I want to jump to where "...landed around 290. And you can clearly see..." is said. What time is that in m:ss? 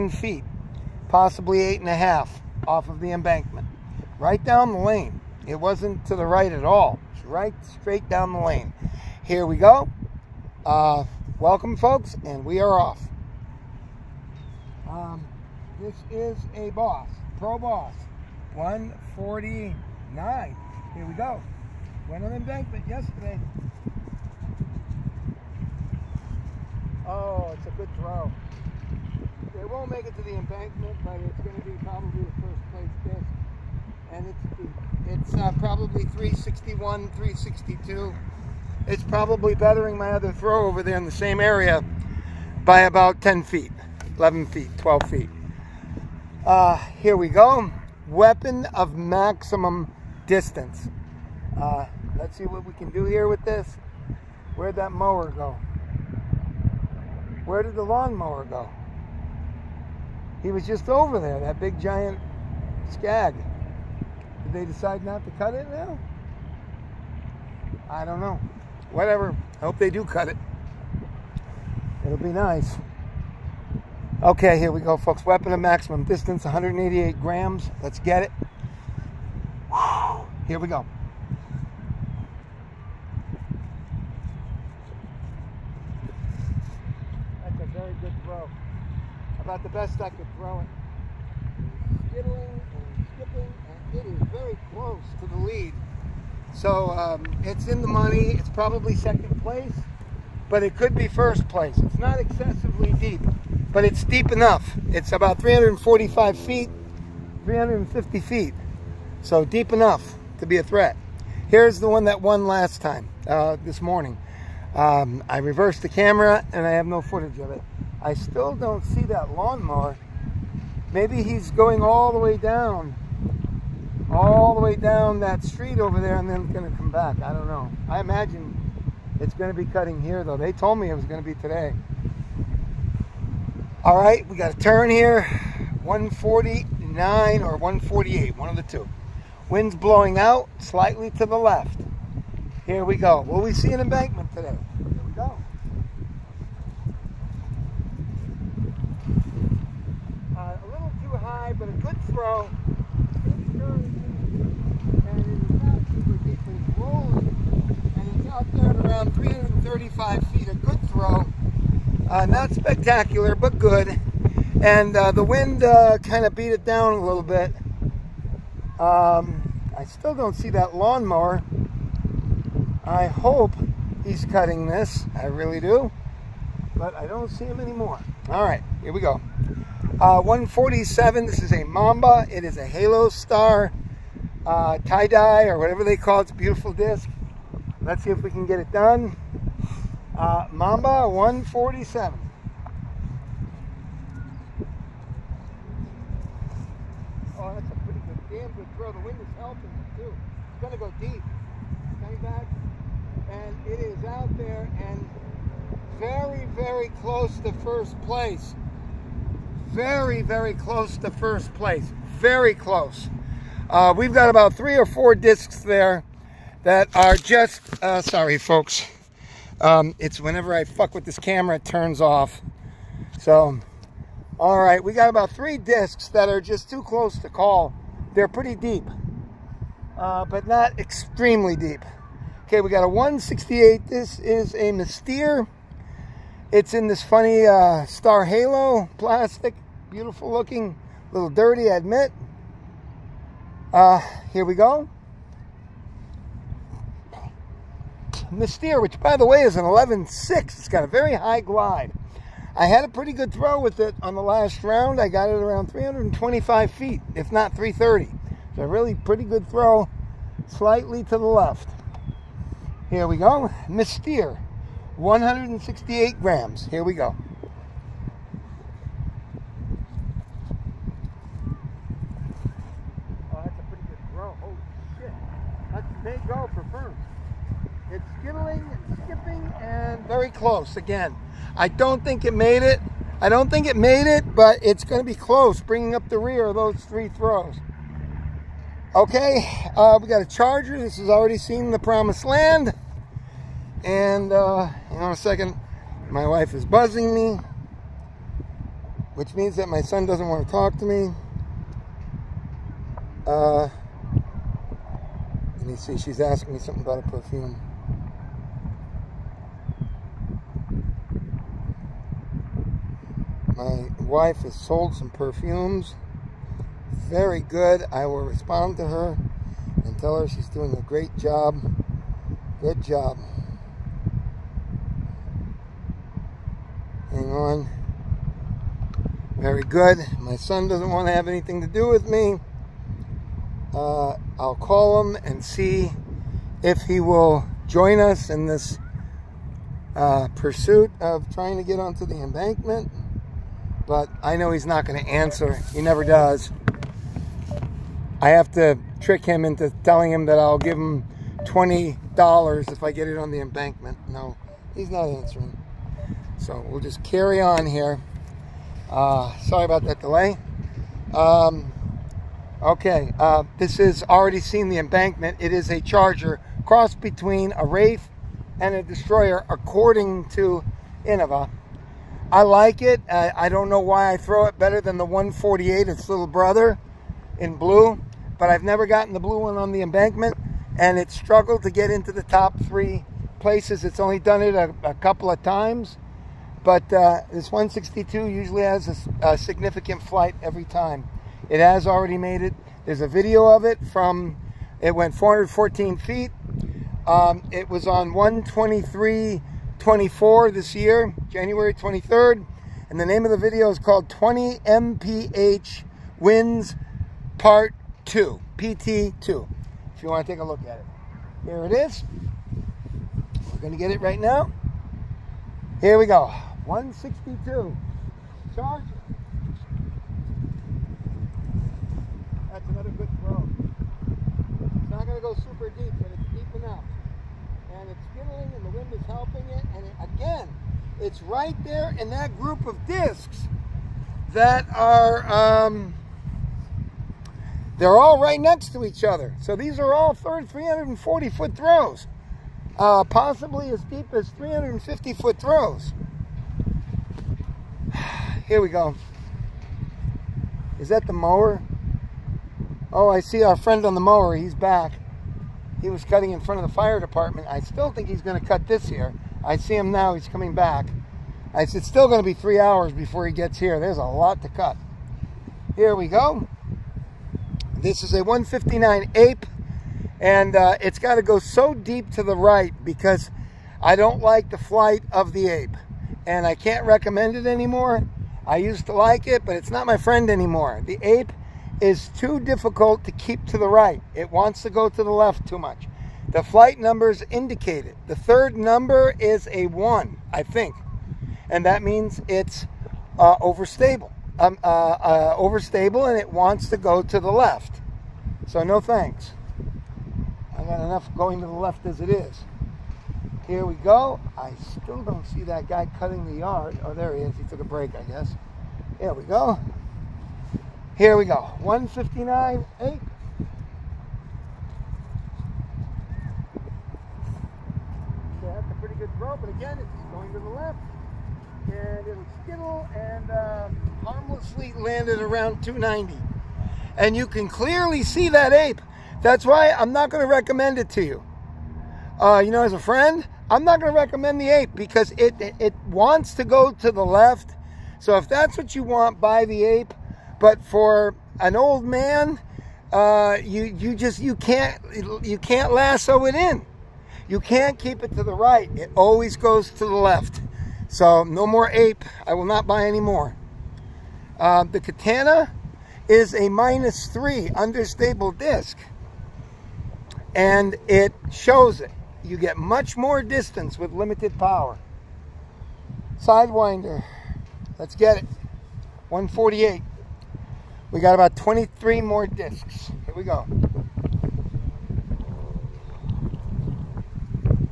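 8:44.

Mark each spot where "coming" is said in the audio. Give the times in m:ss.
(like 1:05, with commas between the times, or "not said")
3:22, 7:40.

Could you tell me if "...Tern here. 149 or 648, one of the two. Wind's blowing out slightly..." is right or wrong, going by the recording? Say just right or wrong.
wrong.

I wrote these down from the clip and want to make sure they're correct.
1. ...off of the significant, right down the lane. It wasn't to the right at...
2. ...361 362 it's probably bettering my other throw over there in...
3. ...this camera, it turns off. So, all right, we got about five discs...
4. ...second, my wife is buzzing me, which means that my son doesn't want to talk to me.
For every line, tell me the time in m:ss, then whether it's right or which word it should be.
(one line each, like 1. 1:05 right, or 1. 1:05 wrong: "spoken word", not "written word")
1. 0:02 wrong: "embankment", not "significant"
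2. 0:36 right
3. 3:41 wrong: "three", not "five"
4. 4:55 right.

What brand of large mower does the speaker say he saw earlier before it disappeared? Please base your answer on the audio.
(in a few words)
Scag.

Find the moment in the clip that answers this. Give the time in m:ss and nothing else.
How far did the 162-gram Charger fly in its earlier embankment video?
6:35.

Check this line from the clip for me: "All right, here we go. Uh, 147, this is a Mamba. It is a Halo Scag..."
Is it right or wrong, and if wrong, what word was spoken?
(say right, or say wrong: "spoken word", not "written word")
wrong: "Star", not "Scag".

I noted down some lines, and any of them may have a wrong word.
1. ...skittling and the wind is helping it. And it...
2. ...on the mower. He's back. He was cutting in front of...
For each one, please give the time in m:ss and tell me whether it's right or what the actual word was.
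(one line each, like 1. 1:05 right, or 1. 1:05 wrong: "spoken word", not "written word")
1. 7:08 right
2. 7:33 right.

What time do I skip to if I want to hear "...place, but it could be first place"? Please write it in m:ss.
1:39.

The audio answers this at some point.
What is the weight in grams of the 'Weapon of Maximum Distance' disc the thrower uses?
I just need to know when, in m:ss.
1:16.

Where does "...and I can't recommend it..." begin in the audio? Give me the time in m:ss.
7:56.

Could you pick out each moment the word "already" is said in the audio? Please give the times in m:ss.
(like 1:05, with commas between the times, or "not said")
4:51, 6:04, 6:31.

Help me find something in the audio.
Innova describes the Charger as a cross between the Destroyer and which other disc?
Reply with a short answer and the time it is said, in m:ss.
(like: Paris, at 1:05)
Wraith, at 6:07.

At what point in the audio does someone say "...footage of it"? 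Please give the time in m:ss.
1:57.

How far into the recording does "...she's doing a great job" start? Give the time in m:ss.
5:20.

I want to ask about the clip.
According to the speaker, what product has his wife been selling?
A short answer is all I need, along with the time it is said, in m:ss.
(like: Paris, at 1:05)
perfumes, at 5:15.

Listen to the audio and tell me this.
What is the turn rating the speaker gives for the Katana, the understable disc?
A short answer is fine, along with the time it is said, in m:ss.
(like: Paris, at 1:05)
minus 3, at 9:16.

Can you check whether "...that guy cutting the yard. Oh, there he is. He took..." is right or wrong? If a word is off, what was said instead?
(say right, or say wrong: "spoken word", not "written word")
right.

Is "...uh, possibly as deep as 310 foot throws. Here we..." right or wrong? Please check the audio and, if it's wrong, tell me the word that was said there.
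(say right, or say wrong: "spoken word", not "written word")
wrong: "350", not "310".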